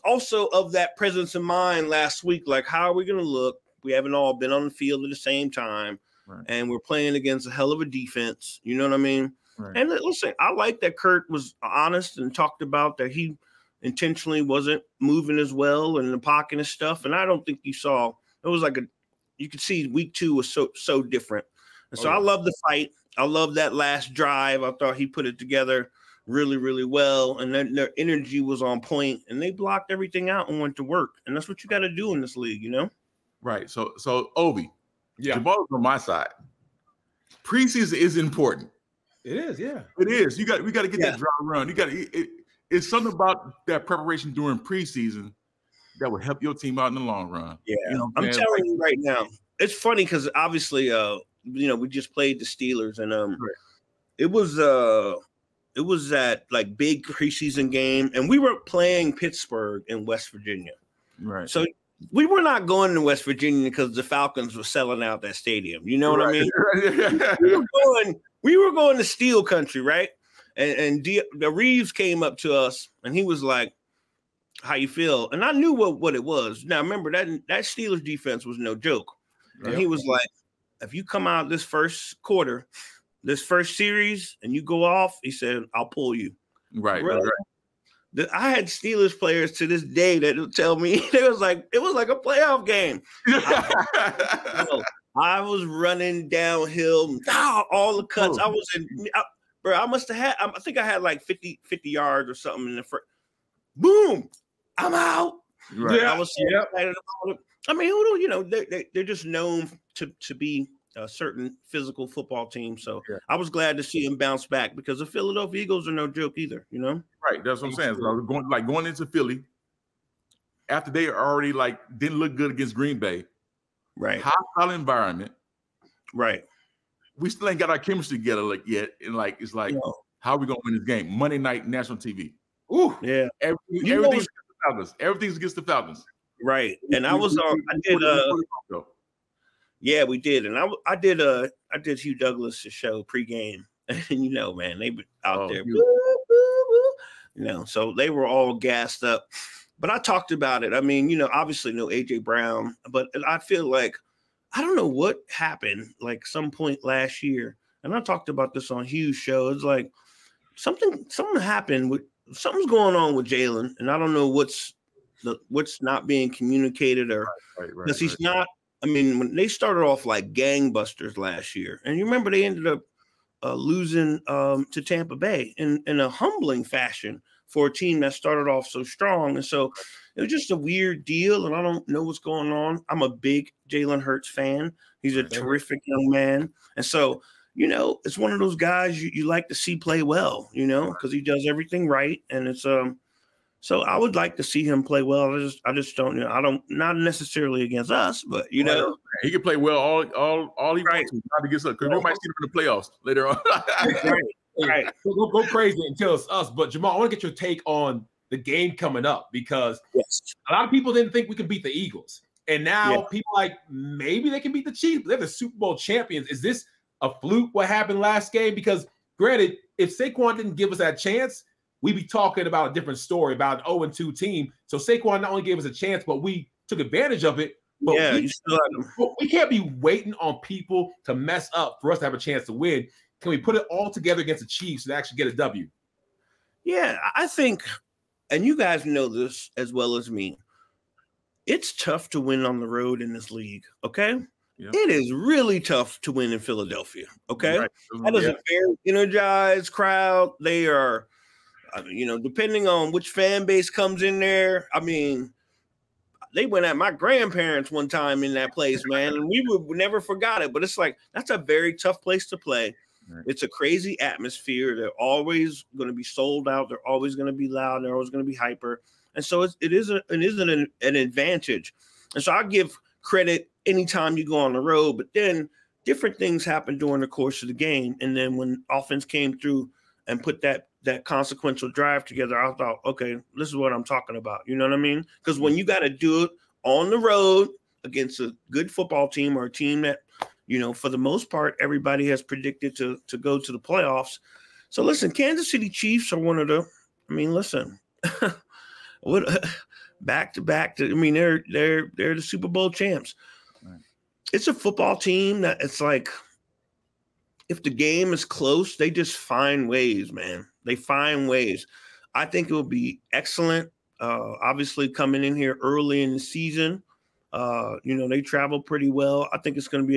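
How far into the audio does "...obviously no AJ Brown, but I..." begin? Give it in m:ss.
2:31.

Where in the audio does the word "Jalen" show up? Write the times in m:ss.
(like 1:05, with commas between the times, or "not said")
2:43, 3:03.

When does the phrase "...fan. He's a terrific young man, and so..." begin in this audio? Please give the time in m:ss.
3:04.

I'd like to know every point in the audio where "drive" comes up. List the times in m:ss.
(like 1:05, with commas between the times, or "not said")
0:24, 4:41.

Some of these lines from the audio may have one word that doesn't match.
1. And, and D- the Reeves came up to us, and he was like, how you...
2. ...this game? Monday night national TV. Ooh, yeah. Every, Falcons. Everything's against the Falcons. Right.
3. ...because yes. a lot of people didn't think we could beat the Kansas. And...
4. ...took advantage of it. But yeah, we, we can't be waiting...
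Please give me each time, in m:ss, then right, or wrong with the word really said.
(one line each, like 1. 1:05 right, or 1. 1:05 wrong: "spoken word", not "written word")
1. 1:10 right
2. 2:10 right
3. 3:29 wrong: "Eagles", not "Kansas"
4. 3:46 right.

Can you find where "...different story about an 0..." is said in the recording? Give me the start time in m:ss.
3:42.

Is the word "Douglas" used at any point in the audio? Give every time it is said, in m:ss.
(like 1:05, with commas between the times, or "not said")
2:22.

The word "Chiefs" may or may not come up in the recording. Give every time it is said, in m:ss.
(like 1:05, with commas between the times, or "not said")
3:34, 3:54, 4:55.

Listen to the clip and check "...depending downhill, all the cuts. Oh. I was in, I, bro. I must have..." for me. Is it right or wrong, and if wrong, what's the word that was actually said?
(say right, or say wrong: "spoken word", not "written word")
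wrong: "running", not "depending".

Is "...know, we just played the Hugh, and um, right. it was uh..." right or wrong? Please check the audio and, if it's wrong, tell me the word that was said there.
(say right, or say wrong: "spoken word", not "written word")
wrong: "Steelers", not "Hugh".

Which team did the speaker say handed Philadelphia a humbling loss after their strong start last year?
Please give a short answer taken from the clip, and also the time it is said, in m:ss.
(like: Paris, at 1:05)
Tampa Bay, at 2:54.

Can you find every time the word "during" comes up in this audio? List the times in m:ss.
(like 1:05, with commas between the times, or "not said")
0:44, 4:36.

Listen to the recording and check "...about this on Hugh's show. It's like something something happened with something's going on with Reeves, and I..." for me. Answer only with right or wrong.
wrong.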